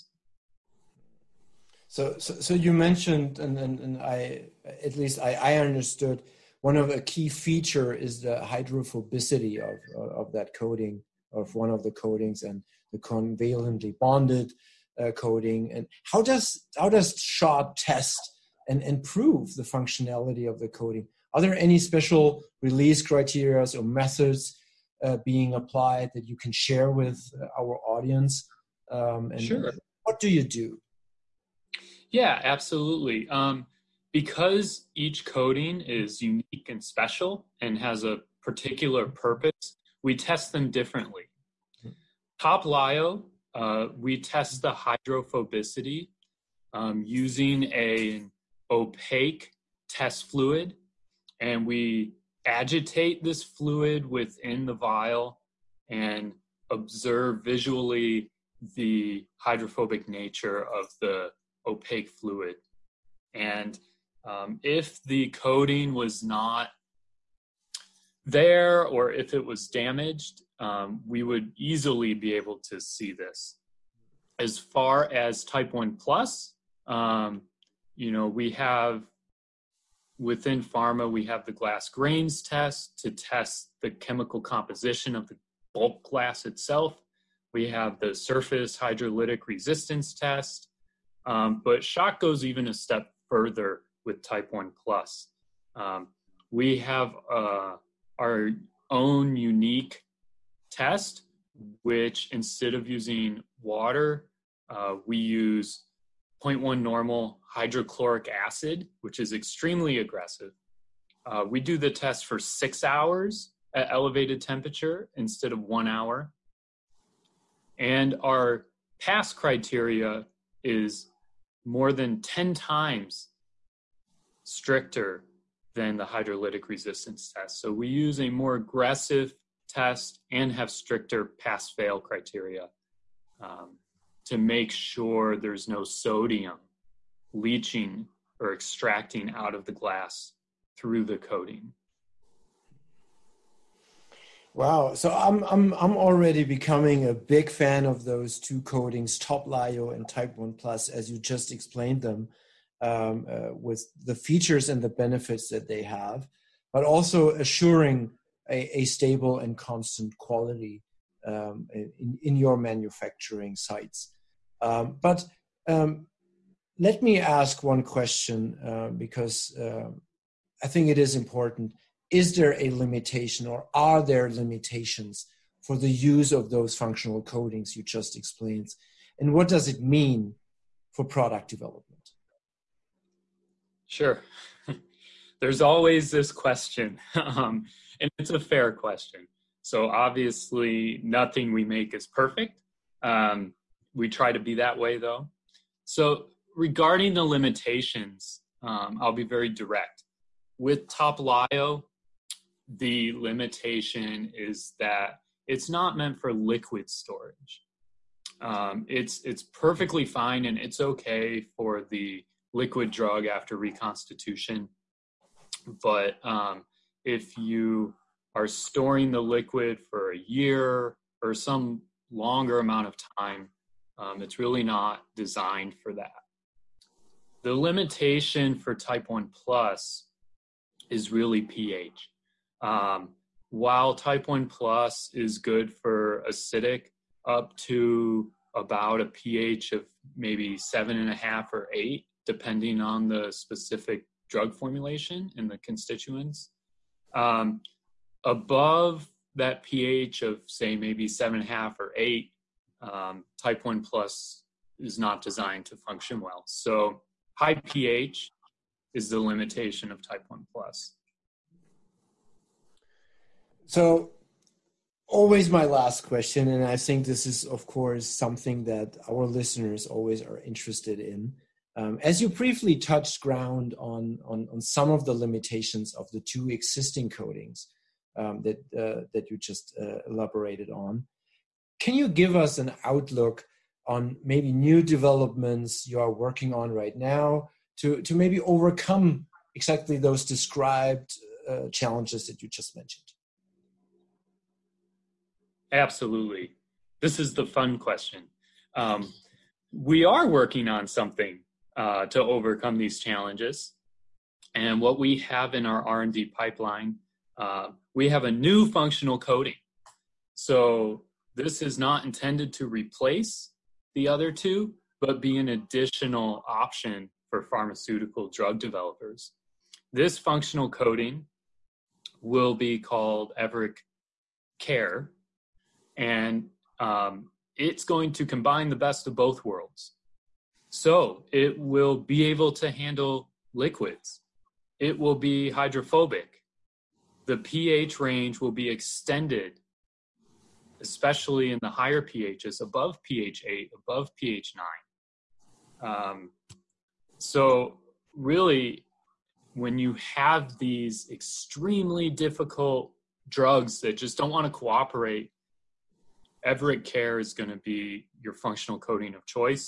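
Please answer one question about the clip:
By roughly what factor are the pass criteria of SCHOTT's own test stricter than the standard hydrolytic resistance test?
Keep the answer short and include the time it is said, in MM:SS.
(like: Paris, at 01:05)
More than 10 times, at 02:01.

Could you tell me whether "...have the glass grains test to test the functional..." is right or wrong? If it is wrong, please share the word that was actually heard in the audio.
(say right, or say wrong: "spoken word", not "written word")
wrong: "chemical", not "functional".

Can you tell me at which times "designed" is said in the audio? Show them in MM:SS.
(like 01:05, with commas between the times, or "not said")
03:45, 04:15.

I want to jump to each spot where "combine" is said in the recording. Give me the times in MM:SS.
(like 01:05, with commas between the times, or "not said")
05:28.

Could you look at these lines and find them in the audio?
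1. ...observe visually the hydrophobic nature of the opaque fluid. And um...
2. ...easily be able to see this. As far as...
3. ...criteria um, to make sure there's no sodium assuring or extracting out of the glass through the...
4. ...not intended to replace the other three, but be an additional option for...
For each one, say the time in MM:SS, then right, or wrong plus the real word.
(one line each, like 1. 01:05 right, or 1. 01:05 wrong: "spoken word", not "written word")
1. 00:56 right
2. 01:11 right
3. 02:11 wrong: "leaching", not "assuring"
4. 05:11 wrong: "two", not "three".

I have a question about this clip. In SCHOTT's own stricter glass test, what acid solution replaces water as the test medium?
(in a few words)
0.1 normal hydrochloric acid.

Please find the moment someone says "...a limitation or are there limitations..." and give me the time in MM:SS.
02:52.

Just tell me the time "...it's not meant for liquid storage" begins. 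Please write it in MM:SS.
03:25.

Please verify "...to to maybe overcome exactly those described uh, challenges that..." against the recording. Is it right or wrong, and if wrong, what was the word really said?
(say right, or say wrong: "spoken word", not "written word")
right.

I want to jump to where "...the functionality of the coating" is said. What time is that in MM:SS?
00:19.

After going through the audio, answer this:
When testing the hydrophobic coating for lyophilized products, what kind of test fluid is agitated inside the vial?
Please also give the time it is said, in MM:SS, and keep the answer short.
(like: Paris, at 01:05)
Opaque test fluid, at 00:48.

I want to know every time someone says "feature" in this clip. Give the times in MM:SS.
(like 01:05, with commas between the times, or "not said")
00:07, 02:34.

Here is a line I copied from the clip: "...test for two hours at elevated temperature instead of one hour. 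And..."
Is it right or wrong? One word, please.
wrong.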